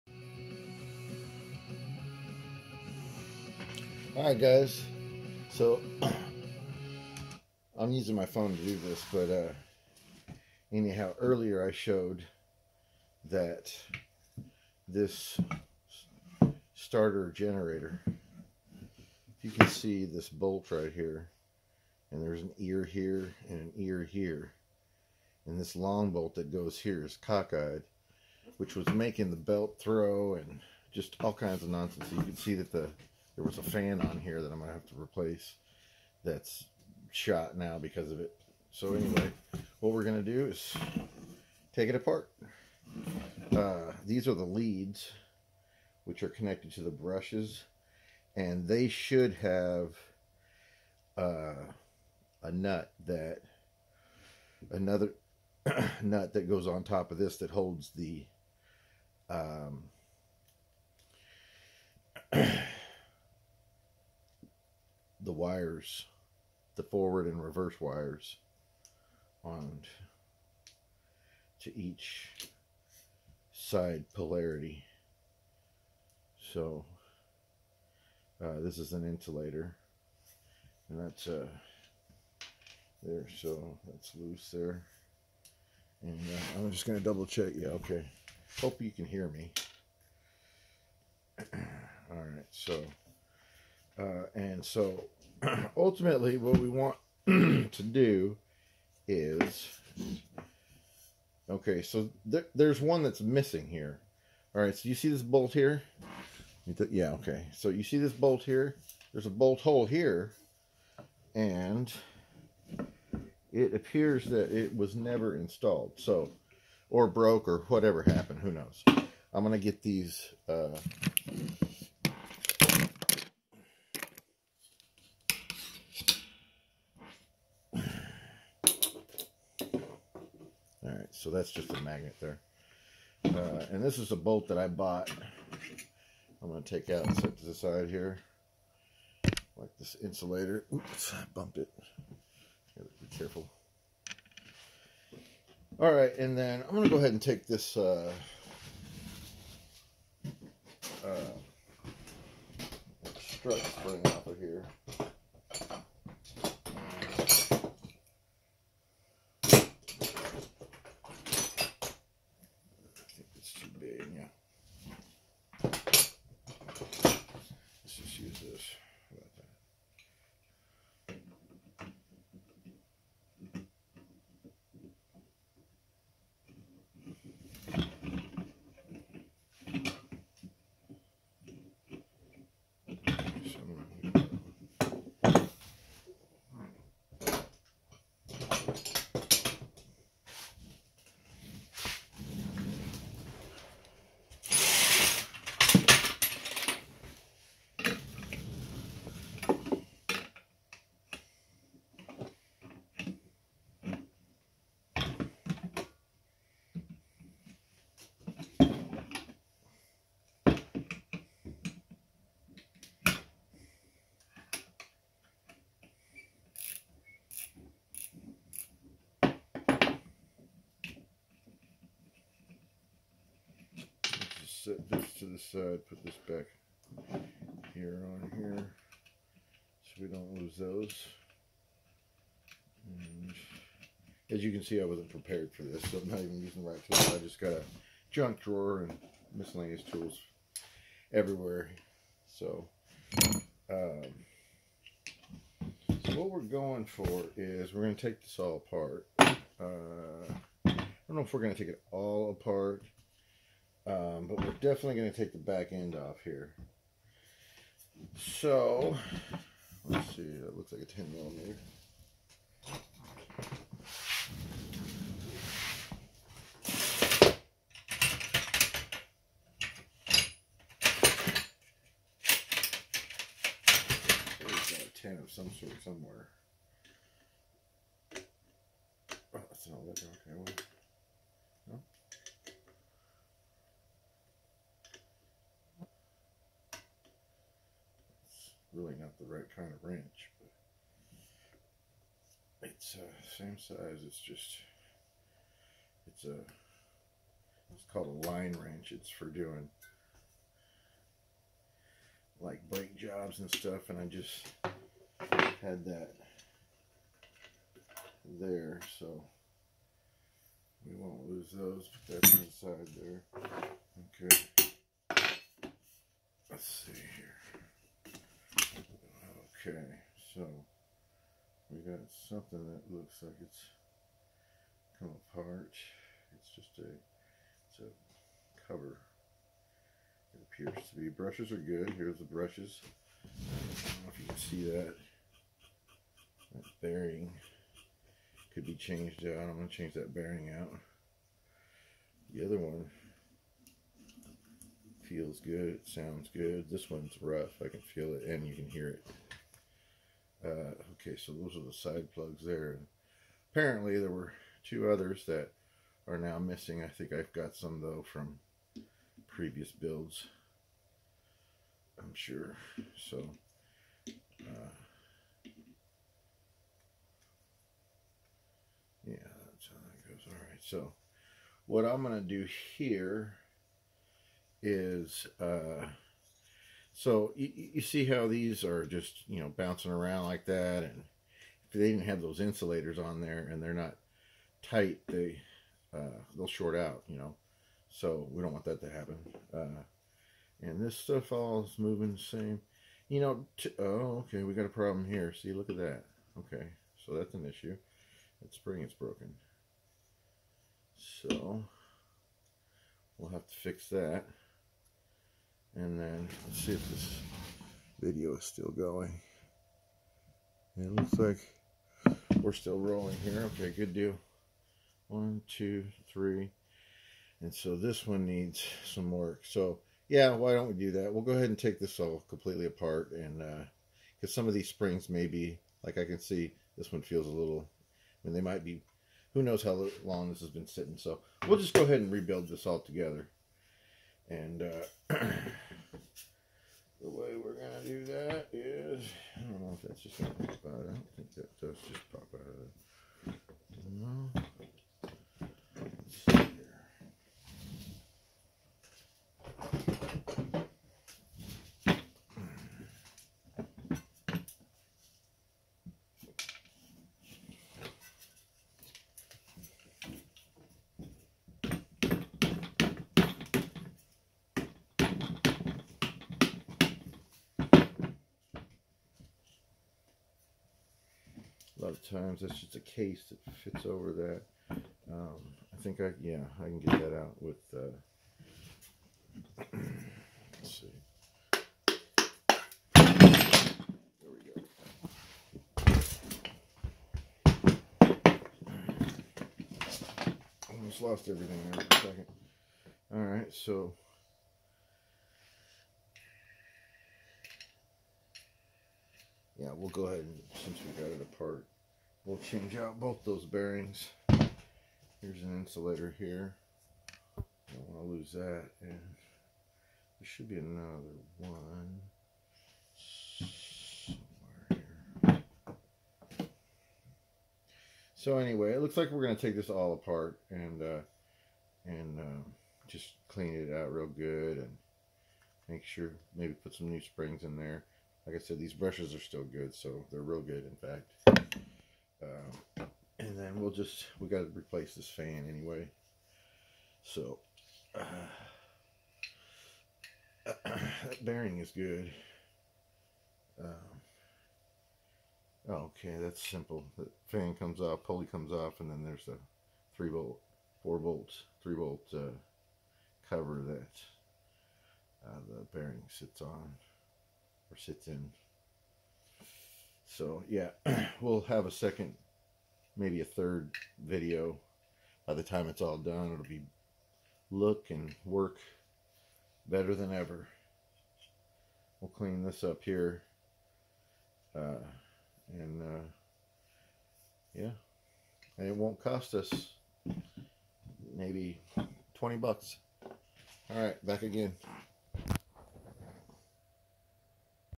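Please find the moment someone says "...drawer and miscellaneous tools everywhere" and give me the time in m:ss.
3:58.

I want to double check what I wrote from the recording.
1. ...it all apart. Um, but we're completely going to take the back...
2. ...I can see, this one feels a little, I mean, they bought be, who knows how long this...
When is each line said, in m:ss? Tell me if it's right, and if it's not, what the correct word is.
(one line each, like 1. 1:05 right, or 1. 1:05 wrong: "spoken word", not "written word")
1. 4:11 wrong: "definitely", not "completely"
2. 7:05 wrong: "might", not "bought".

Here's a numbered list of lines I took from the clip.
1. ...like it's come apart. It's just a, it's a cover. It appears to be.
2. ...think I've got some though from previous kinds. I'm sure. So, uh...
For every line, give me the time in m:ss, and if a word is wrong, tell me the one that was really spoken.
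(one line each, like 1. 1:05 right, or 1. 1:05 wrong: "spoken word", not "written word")
1. 5:23 right
2. 5:56 wrong: "builds", not "kinds".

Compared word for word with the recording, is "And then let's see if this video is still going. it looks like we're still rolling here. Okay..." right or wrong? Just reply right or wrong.
right.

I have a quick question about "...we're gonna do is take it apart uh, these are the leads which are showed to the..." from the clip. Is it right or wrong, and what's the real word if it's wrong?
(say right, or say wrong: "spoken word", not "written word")
wrong: "connected", not "showed".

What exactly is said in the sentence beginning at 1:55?
So, or broke or whatever happened, who knows.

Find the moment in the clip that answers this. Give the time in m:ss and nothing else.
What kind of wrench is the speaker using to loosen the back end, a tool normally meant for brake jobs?
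4:58.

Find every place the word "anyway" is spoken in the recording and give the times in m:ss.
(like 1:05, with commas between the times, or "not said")
0:38, 8:38, 8:55.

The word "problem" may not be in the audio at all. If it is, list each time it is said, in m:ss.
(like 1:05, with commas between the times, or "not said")
6:34.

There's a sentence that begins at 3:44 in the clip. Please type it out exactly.
set this to the side, put this back here on here so we don't lose those.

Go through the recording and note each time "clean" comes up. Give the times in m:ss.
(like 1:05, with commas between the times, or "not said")
8:43, 9:32.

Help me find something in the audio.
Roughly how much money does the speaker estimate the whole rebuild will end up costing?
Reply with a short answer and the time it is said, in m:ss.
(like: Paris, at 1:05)
20 bucks, at 9:42.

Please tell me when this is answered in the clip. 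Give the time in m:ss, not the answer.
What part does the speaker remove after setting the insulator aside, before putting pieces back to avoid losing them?
2:33.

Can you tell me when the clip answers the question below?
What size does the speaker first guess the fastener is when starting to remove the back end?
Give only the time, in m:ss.
4:20.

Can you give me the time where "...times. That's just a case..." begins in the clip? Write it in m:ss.
7:52.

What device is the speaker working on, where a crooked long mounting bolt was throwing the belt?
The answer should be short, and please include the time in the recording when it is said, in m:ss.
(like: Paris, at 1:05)
starter generator, at 0:16.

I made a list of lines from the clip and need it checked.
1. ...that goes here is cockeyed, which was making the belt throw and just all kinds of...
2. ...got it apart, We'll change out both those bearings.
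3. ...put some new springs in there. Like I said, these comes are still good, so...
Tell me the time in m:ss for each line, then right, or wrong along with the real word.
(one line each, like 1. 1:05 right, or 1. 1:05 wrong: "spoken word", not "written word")
1. 0:26 right
2. 8:21 right
3. 8:46 wrong: "brushes", not "comes".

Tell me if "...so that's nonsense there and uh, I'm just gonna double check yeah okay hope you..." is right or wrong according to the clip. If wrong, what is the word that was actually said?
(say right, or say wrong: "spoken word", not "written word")
wrong: "loose", not "nonsense".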